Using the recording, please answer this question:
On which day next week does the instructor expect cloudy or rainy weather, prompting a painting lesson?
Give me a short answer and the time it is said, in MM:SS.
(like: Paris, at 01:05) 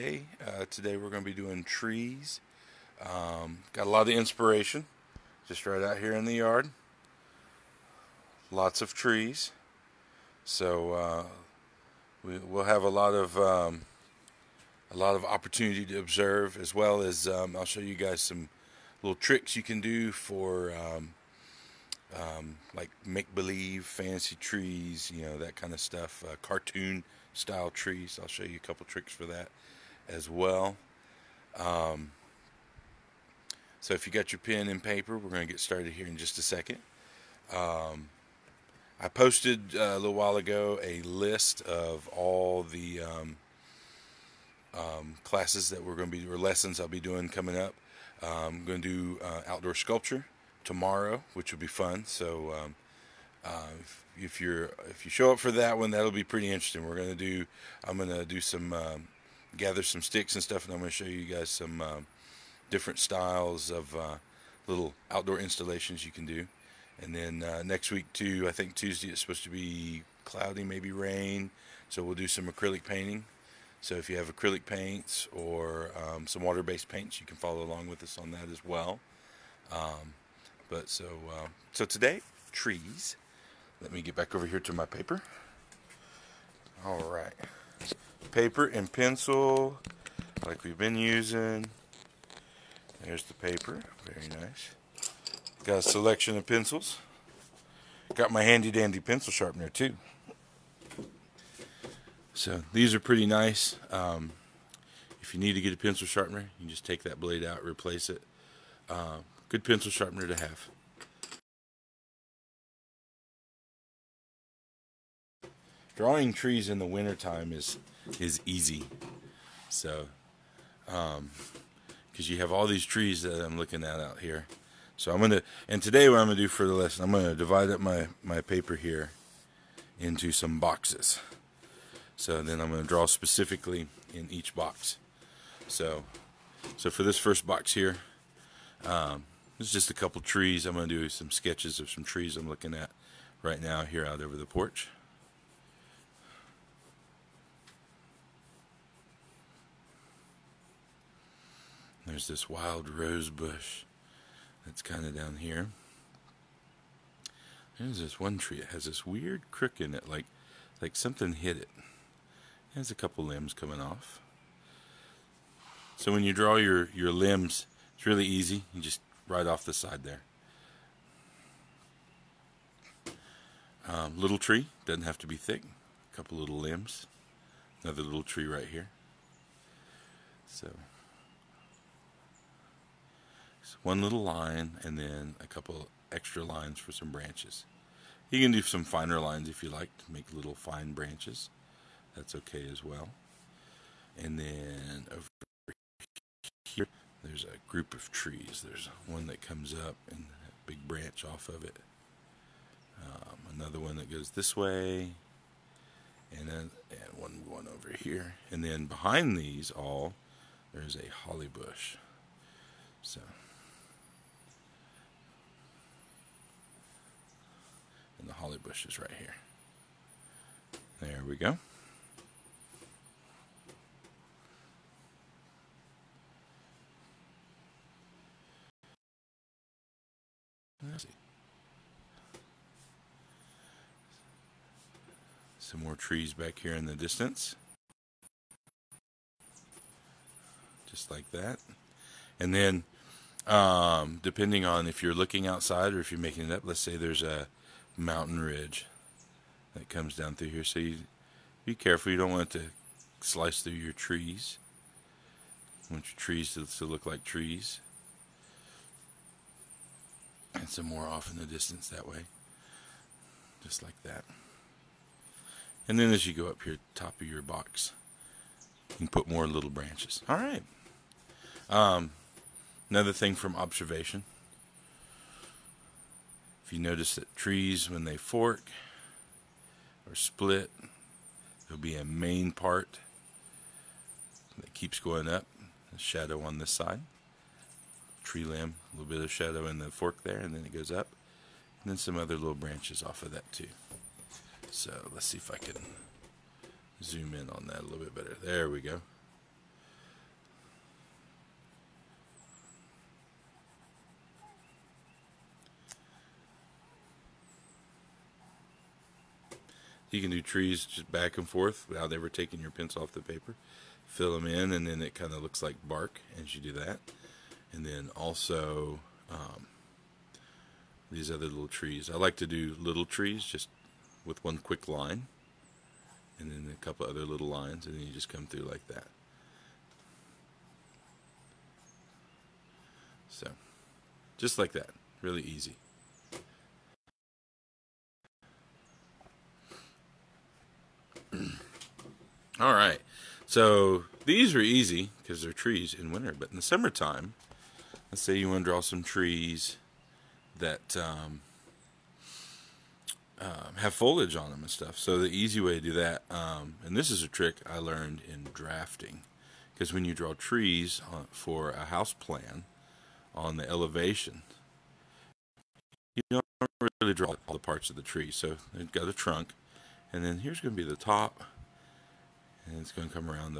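Tuesday, at 01:08.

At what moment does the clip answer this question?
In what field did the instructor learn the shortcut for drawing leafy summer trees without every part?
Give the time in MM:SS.
05:58.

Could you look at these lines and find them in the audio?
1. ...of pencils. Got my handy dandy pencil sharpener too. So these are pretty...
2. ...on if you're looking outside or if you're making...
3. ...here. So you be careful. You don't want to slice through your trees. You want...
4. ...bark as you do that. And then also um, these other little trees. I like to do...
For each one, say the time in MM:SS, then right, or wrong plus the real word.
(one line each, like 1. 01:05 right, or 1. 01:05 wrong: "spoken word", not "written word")
1. 01:36 right
2. 04:04 right
3. 04:10 right
4. 05:15 right.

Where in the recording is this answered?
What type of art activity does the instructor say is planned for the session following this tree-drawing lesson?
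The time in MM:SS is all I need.
00:49.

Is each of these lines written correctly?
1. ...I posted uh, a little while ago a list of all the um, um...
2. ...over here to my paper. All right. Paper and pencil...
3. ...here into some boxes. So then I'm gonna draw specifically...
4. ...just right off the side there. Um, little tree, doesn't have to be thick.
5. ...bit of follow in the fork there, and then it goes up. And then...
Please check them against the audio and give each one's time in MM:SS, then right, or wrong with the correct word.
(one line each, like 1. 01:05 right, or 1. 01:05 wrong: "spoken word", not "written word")
1. 00:39 right
2. 01:24 right
3. 02:08 right
4. 02:48 right
5. 04:49 wrong: "shadow", not "follow".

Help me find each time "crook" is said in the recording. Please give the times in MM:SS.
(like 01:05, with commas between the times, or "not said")
02:39.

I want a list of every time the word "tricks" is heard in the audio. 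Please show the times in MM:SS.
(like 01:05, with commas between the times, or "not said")
00:19, 00:28, 05:57.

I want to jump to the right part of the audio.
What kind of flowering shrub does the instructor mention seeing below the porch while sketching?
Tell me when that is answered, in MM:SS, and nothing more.
02:32.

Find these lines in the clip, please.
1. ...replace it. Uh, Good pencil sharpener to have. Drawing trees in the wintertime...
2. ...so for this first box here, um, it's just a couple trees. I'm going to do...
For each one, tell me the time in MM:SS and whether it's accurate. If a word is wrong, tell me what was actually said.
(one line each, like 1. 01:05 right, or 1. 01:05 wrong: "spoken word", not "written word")
1. 01:47 right
2. 02:16 right.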